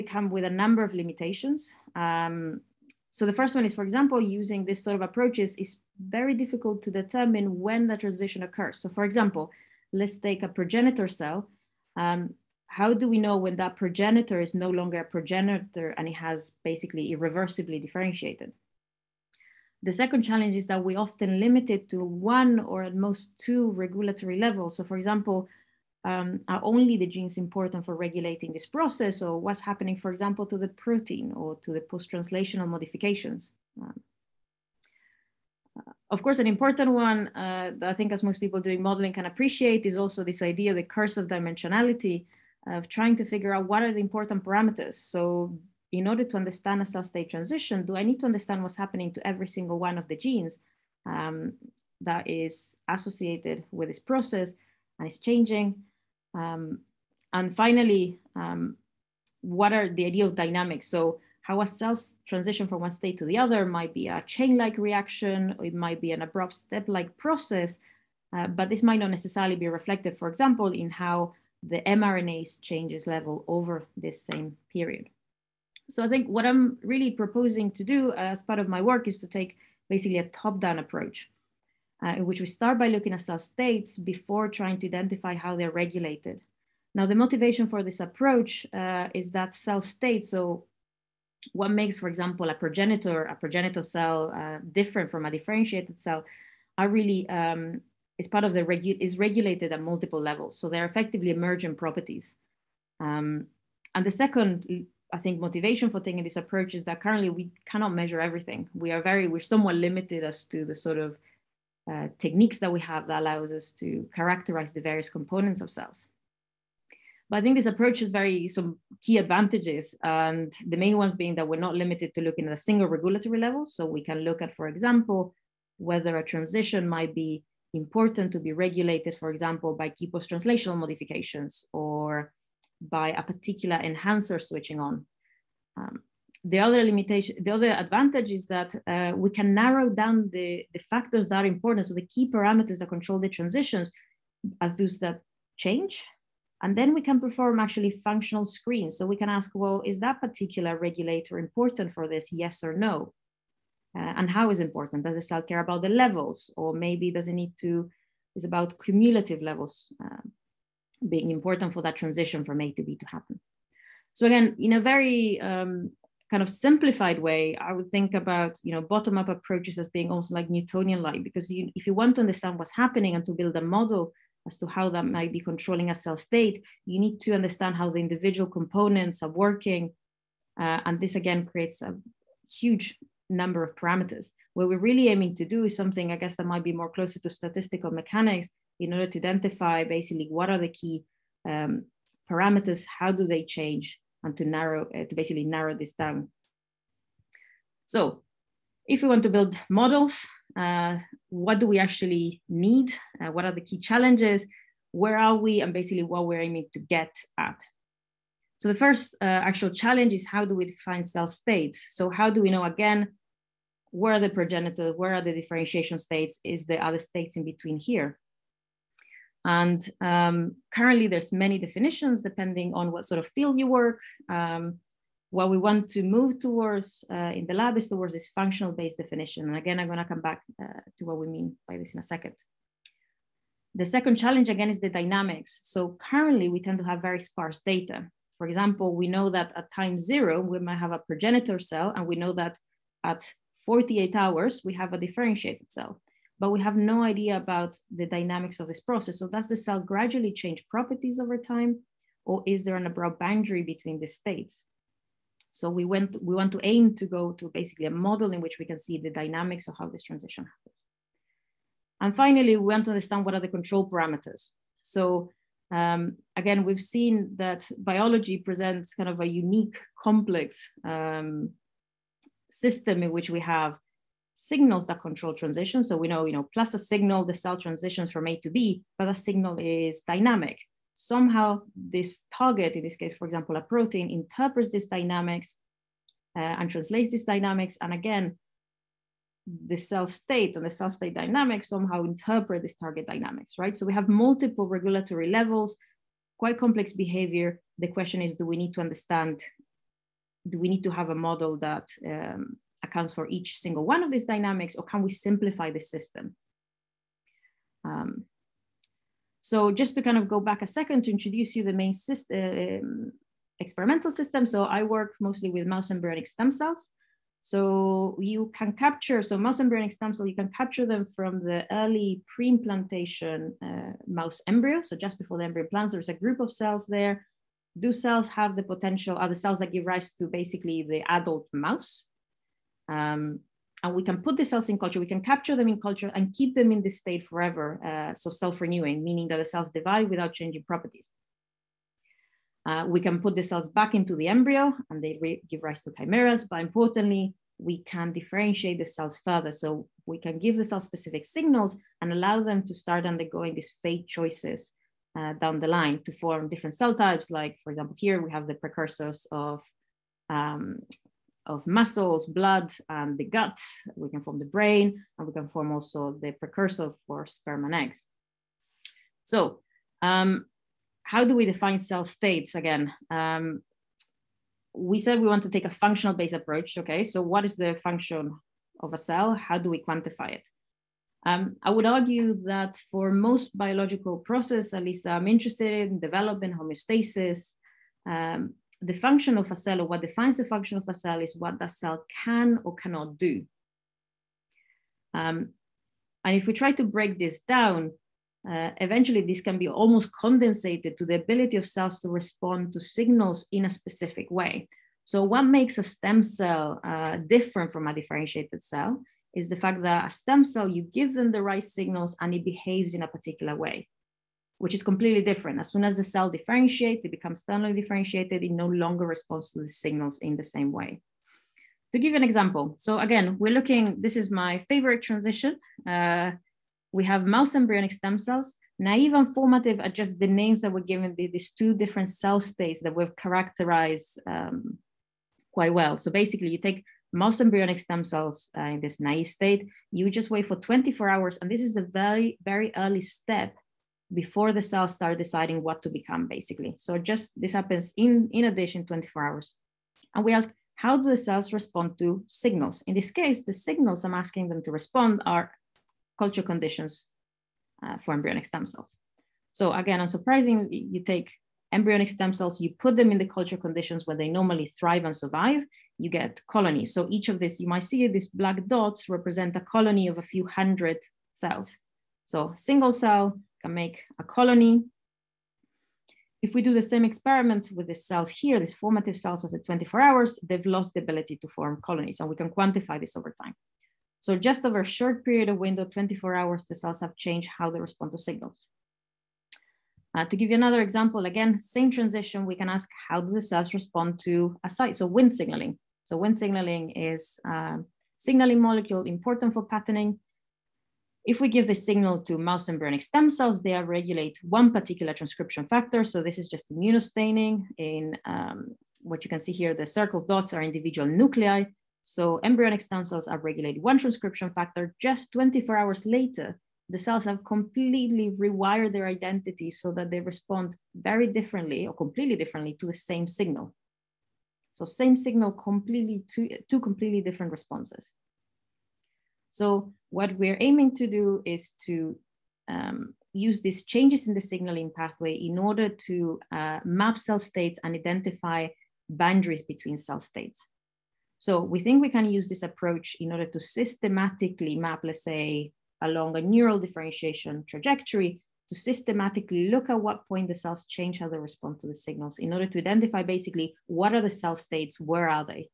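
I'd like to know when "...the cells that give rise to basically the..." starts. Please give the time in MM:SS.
05:29.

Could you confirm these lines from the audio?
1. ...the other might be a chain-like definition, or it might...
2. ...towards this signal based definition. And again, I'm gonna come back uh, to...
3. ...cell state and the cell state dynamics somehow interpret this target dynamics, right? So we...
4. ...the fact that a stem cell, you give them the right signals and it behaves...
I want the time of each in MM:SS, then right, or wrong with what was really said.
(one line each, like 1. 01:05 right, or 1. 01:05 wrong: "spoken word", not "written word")
1. 01:03 wrong: "reaction", not "definition"
2. 03:47 wrong: "functional", not "signal"
3. 04:49 right
4. 06:49 right.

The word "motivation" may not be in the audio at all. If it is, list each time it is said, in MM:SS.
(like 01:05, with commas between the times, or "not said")
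01:27, 01:45.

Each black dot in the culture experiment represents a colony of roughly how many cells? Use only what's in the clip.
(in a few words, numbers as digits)
a few hundred.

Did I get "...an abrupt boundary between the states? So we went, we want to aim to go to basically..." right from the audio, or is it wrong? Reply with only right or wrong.
right.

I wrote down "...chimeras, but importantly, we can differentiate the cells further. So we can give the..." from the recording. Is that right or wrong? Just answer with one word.
right.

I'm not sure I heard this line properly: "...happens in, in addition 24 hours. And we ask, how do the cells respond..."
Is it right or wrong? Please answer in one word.
right.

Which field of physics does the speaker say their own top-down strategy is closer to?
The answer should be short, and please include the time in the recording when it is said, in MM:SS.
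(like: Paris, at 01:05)
statistical mechanics, at 03:07.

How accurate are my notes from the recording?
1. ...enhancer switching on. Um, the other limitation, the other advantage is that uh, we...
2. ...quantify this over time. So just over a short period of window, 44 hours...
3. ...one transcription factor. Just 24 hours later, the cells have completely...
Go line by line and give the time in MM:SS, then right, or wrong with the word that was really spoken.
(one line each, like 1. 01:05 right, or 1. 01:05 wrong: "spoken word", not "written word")
1. 02:13 right
2. 08:02 wrong: "24", not "44"
3. 08:33 right.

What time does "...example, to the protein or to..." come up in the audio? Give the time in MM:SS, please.
00:30.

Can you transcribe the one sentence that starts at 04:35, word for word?
So we know, you know, plus a signal, the cell transitions from A to B, but a signal is dynamic.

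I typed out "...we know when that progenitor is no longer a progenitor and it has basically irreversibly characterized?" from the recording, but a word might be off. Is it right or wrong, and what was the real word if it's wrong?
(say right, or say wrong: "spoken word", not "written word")
wrong: "differentiated", not "characterized".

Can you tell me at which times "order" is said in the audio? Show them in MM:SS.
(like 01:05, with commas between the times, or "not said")
00:46, 03:08, 08:55, 09:03, 09:12.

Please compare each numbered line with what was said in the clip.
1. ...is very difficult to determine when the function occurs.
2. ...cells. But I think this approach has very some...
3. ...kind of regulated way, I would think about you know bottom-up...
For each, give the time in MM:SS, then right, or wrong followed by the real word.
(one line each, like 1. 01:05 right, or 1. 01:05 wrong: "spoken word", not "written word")
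1. 00:05 wrong: "transition", not "function"
2. 01:55 right
3. 02:46 wrong: "simplified", not "regulated".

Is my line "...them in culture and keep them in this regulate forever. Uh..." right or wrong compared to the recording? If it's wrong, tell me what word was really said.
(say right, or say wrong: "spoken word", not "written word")
wrong: "state", not "regulate".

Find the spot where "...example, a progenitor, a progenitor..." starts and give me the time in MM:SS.
01:32.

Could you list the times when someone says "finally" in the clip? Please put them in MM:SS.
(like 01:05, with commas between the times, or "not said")
00:57, 04:22.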